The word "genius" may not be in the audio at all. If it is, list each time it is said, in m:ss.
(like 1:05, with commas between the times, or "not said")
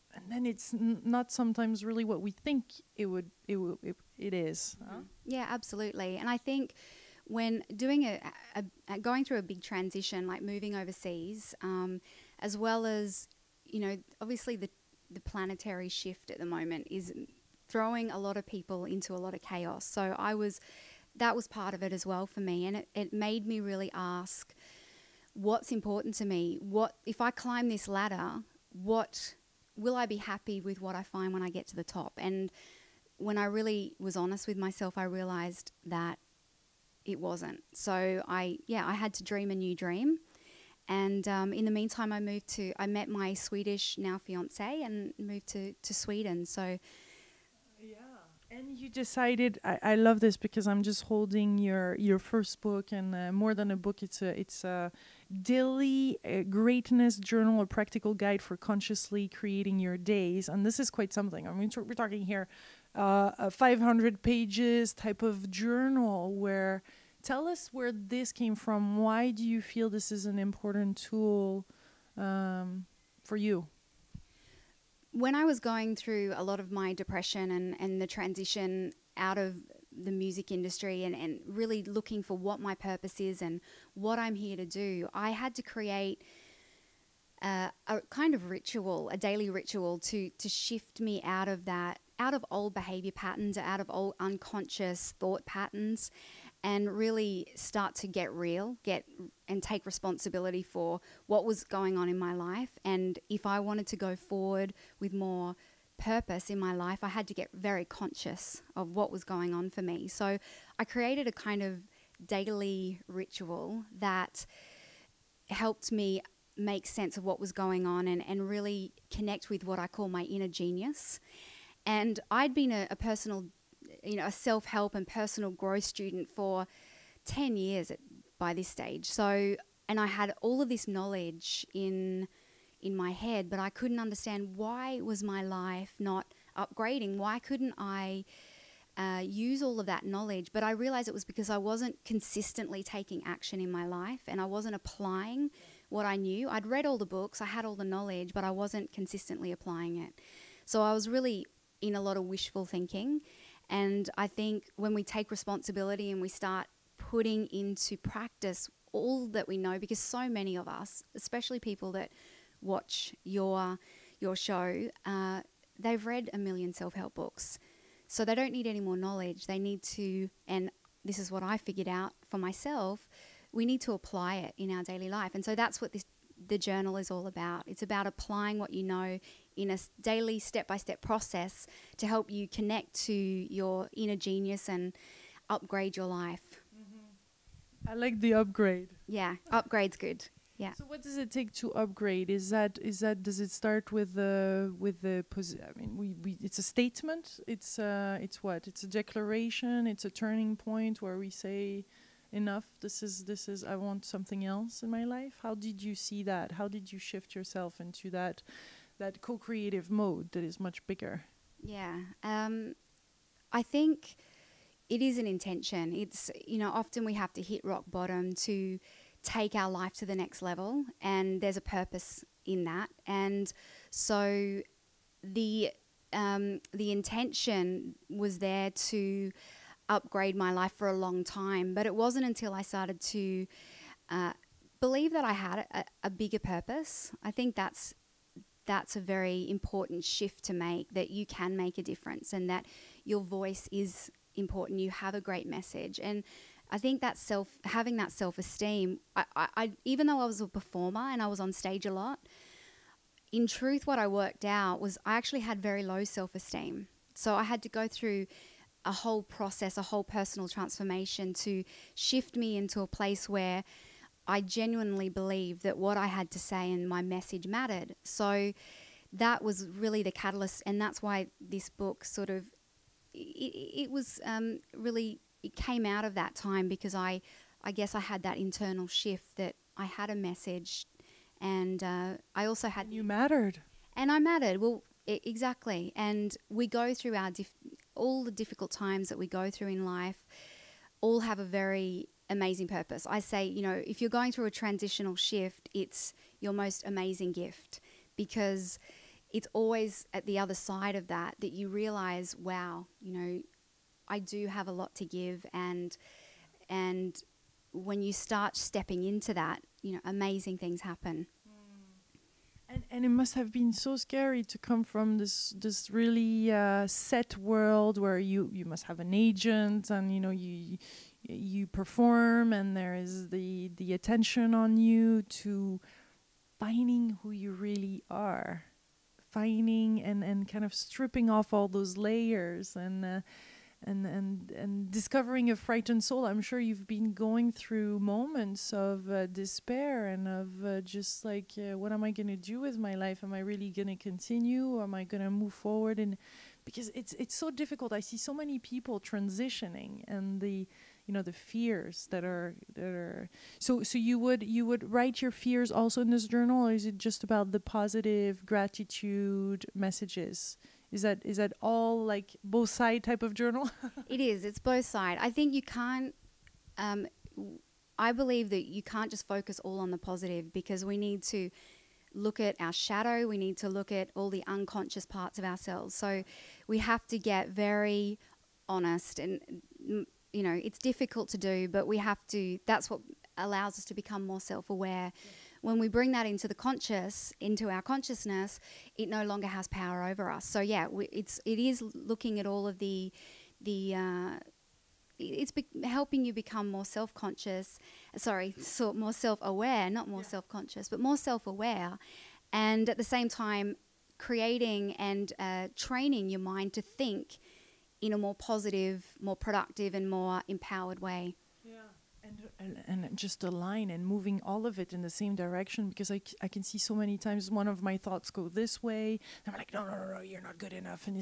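2:00, 3:04.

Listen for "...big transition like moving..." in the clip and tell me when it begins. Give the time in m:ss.
0:09.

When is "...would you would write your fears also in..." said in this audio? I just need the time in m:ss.
5:54.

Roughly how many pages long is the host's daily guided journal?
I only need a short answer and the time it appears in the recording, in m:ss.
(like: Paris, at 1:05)
500, at 1:03.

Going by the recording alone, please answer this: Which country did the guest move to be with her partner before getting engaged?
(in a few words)
Sweden.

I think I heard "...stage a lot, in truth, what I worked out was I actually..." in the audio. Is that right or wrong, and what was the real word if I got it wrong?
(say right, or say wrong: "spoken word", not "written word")
right.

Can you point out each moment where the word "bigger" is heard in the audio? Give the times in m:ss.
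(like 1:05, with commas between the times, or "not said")
3:30, 3:56.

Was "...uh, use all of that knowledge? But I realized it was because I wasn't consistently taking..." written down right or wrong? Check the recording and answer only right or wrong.
right.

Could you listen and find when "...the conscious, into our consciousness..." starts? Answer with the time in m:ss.
6:26.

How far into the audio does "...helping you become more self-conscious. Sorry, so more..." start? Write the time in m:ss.
6:35.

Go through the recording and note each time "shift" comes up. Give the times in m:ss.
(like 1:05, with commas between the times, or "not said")
0:15, 1:30, 3:26, 4:00, 4:21, 4:38, 4:55.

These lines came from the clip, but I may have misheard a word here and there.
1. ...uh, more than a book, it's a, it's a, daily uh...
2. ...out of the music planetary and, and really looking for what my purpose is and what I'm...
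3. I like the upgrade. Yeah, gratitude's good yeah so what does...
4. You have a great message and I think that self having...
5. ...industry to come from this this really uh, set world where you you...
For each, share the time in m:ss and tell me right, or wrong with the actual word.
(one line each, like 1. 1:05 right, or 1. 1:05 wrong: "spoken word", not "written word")
1. 0:53 right
2. 1:19 wrong: "industry", not "planetary"
3. 3:07 wrong: "upgrade", not "gratitude"
4. 4:04 right
5. 5:13 wrong: "scary", not "industry".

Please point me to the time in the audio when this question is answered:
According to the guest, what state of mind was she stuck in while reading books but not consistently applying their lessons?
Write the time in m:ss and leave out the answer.
2:32.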